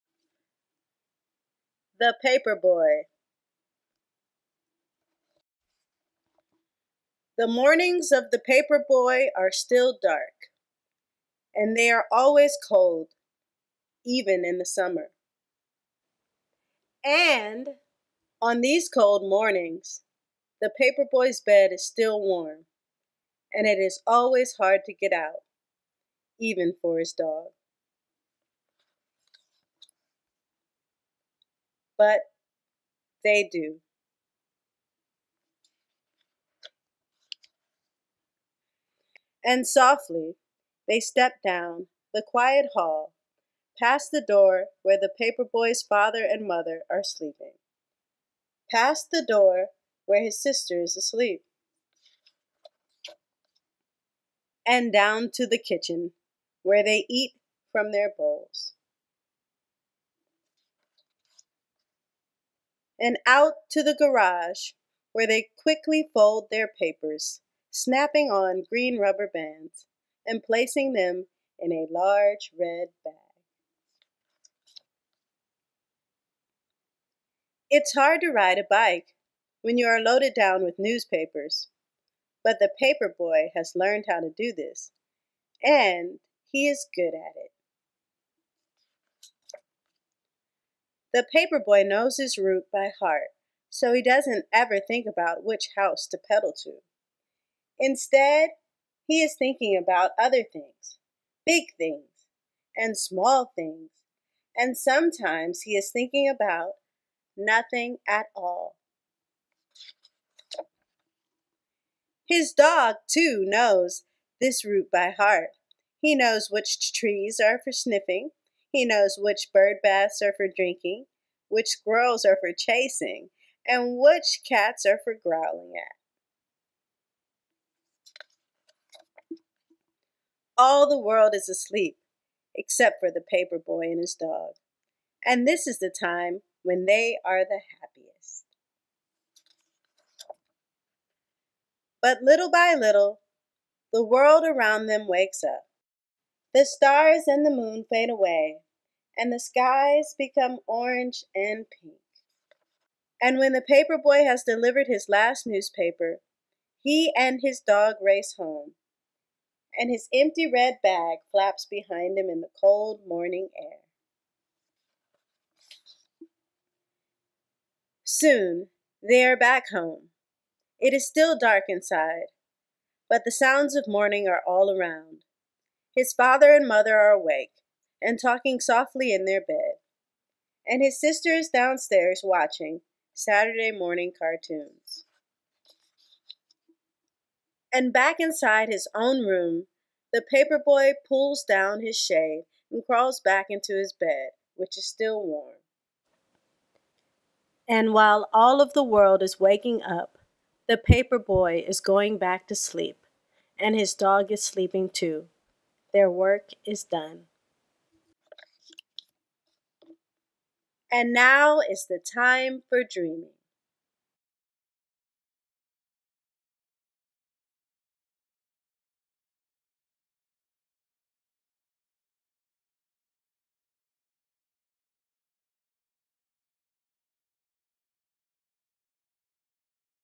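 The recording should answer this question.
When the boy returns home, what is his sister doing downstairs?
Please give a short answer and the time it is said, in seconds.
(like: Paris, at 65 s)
watching Saturday morning cartoons, at 182 s.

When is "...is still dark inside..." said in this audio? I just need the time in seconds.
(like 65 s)
170 s.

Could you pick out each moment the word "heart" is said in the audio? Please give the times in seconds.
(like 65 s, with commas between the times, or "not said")
93 s, 115 s.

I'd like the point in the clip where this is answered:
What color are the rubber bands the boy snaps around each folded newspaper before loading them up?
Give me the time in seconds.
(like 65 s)
68 s.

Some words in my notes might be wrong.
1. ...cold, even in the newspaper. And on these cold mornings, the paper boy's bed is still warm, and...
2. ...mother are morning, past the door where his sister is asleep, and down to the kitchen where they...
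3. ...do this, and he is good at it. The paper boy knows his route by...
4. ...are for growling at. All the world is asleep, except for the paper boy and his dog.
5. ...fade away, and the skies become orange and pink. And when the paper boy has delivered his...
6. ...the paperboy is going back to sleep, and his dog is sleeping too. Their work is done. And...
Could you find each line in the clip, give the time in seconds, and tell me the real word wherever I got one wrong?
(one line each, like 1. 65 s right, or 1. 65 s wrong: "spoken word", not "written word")
1. 12 s wrong: "summer", not "newspaper"
2. 46 s wrong: "sleeping", not "morning"
3. 84 s right
4. 124 s right
5. 147 s right
6. 200 s right.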